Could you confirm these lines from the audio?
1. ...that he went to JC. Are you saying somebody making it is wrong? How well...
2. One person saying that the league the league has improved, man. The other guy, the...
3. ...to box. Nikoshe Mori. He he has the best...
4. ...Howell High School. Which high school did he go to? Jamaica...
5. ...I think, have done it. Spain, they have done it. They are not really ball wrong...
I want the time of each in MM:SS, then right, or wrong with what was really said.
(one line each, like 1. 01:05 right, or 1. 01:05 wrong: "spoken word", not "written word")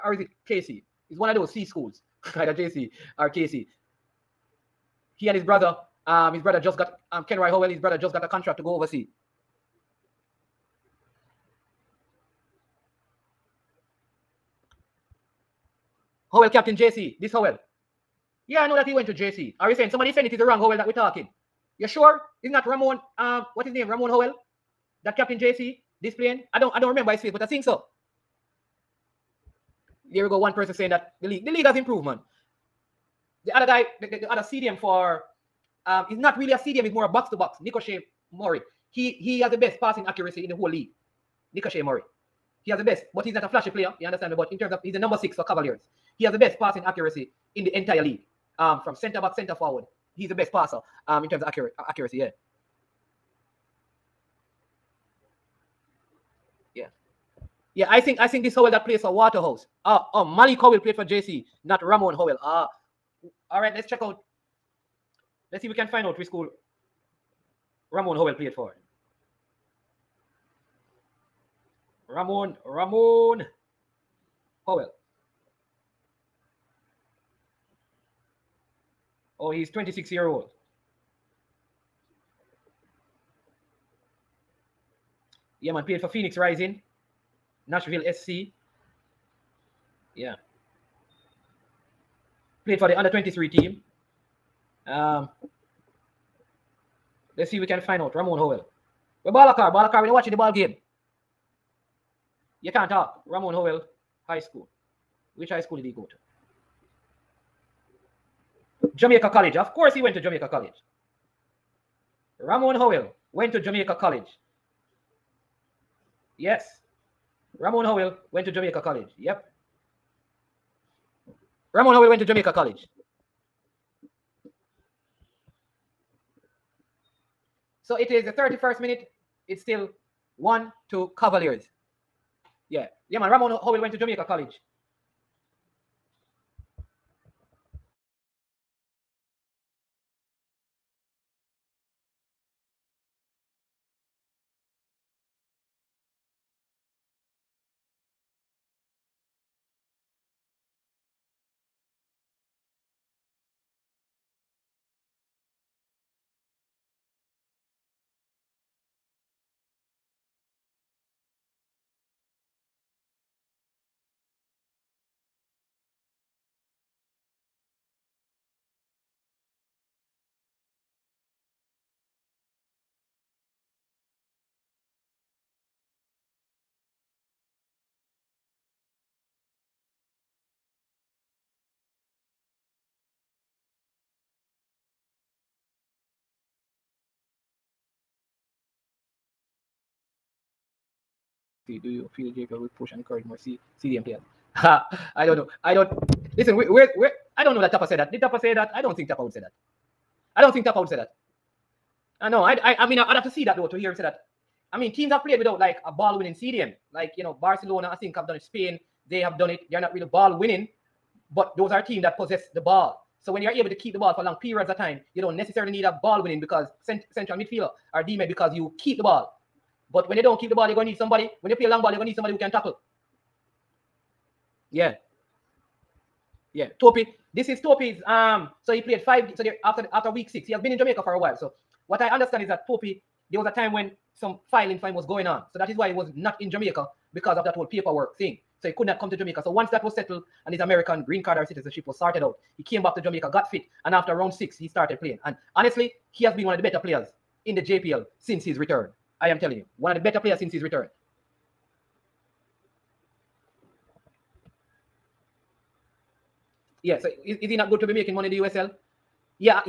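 1. 00:18 wrong: "saying", not "making"
2. 00:30 right
3. 00:37 right
4. 01:43 right
5. 03:27 wrong: "winning", not "wrong".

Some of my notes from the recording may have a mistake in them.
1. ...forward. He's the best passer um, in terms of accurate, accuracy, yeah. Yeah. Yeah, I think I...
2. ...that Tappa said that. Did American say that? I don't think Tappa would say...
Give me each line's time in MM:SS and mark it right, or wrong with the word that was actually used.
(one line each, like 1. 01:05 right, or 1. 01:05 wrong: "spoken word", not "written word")
1. 00:49 right
2. 03:17 wrong: "Tappa", not "American".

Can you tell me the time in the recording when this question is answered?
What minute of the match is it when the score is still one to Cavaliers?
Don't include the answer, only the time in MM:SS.
02:08.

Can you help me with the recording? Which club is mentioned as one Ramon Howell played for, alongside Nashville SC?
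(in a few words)
Phoenix Rising.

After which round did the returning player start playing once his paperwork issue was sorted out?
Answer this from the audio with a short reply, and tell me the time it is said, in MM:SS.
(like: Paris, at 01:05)
Round 6, at 04:04.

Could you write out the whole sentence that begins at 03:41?
When you play a long ball, you're going to need somebody who can tackle.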